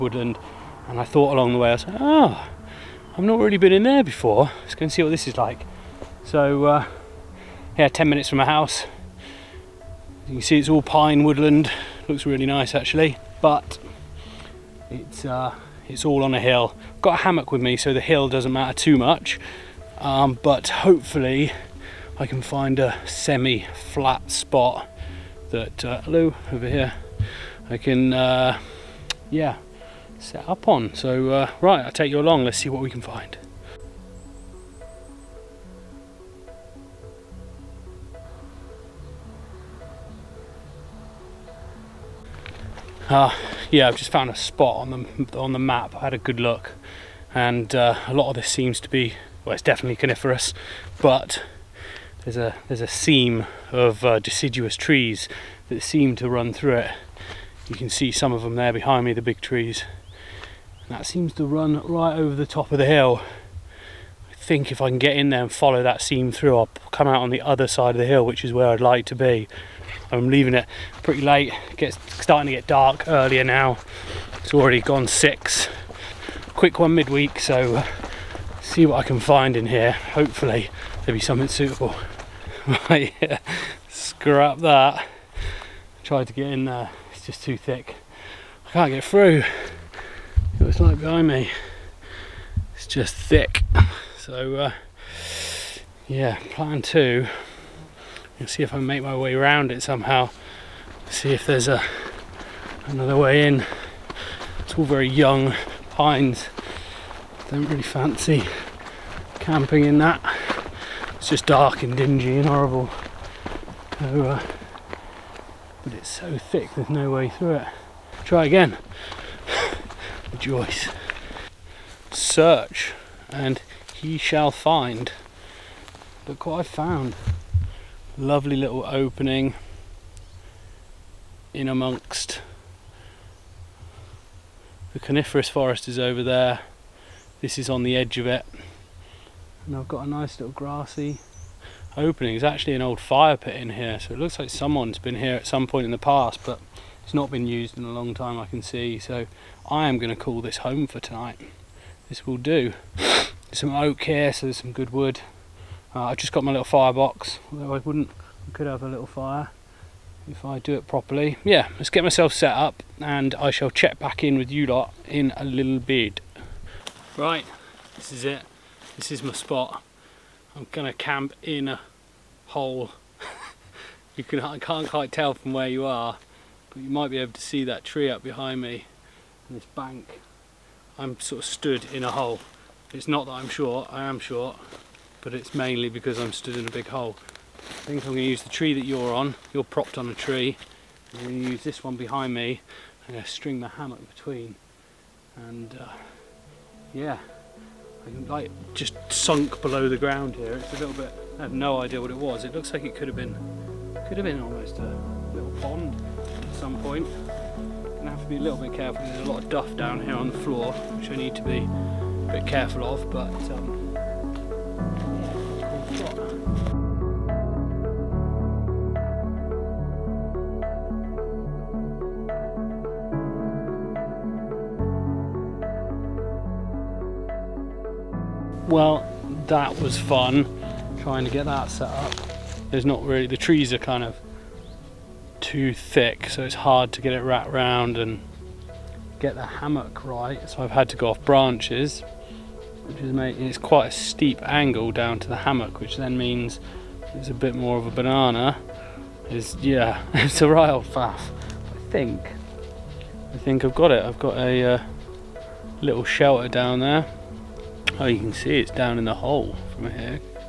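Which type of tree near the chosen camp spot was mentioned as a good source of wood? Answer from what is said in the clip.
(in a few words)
oak.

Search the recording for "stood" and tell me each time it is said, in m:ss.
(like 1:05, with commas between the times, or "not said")
3:01, 3:06.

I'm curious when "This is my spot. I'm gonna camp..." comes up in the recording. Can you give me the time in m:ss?
2:48.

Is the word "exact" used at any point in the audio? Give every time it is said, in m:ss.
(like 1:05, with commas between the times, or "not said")
not said.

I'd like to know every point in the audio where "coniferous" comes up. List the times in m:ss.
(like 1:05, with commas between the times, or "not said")
0:49, 2:14.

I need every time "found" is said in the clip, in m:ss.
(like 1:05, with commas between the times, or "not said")
0:44, 2:06.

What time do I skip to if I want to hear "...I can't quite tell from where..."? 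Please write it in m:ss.
2:54.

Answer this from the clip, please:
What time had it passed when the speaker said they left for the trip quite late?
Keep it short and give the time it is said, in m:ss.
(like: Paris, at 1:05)
six, at 1:15.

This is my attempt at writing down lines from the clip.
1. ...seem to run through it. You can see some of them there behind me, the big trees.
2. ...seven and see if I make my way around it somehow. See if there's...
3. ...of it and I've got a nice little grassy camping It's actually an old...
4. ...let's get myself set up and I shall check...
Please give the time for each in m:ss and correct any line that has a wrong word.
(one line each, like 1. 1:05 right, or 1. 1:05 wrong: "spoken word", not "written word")
1. 0:55 right
2. 1:36 wrong: "two", not "seven"
3. 2:18 wrong: "opening", not "camping"
4. 2:41 right.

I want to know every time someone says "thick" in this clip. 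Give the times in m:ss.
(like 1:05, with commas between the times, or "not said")
1:27, 1:33, 1:56, 3:55.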